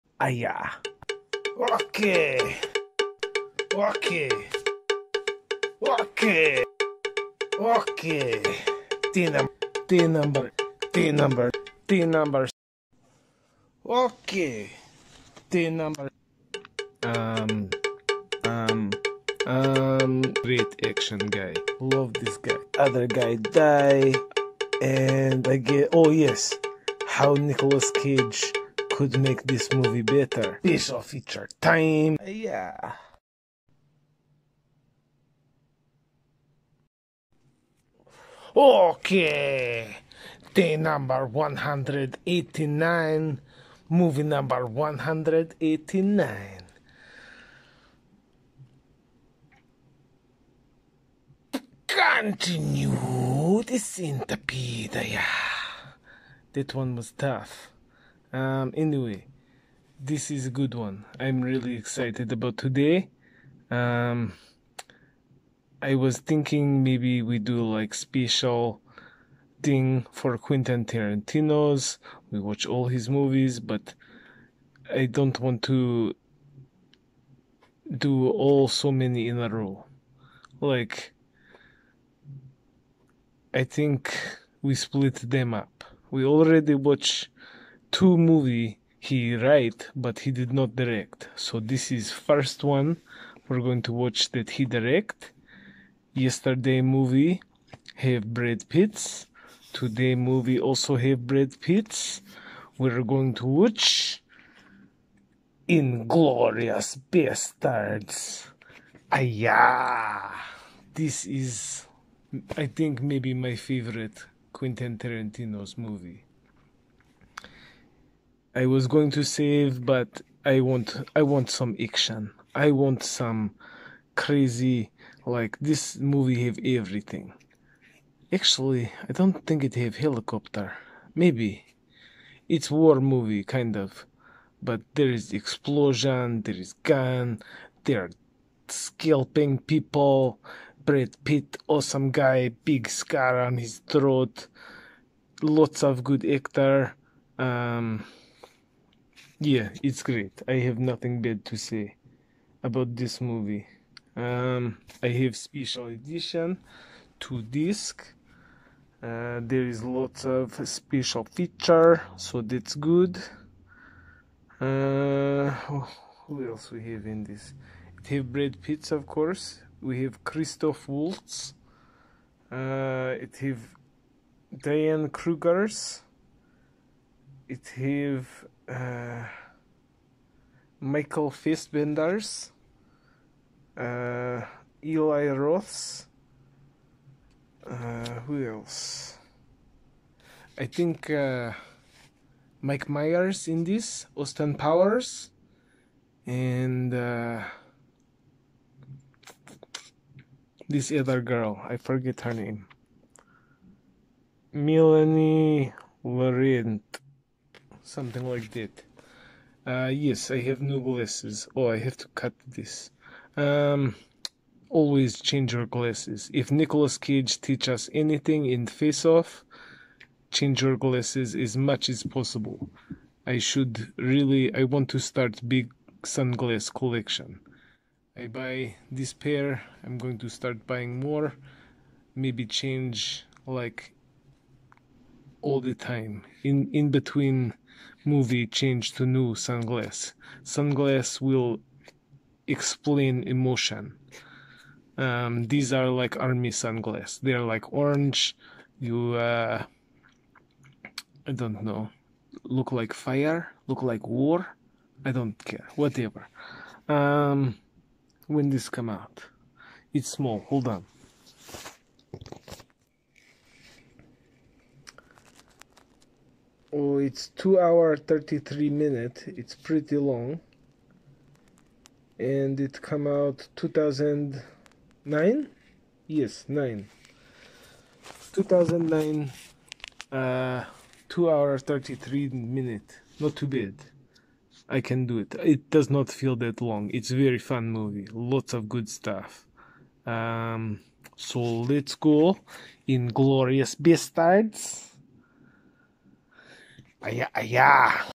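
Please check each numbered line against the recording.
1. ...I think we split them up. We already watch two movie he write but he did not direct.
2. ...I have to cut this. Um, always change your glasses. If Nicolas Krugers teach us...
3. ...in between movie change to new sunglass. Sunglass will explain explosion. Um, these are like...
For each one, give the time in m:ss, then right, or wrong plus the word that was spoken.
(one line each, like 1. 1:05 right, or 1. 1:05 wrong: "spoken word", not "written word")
1. 1:23 right
2. 3:31 wrong: "Cage", not "Krugers"
3. 3:56 wrong: "emotion", not "explosion".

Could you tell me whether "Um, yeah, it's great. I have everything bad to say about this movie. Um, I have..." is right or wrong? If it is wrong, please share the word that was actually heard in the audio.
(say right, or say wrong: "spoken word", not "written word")
wrong: "nothing", not "everything".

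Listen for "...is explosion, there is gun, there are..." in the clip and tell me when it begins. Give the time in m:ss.
2:15.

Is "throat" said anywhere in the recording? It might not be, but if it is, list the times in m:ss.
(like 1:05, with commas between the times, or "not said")
2:23.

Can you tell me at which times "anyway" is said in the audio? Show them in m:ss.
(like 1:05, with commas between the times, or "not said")
0:58.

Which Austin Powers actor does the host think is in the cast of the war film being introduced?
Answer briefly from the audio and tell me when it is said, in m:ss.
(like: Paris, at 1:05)
Mike Myers, at 3:12.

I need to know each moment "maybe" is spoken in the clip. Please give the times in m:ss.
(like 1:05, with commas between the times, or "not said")
1:06, 1:53, 2:11, 3:52.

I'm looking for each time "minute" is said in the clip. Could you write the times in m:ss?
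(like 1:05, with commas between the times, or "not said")
4:28, 4:42.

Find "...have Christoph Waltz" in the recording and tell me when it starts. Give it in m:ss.
2:50.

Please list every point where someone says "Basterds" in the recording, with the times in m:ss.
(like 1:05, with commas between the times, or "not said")
1:47, 4:53.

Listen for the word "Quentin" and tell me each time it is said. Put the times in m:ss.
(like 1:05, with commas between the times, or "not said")
1:10, 1:54.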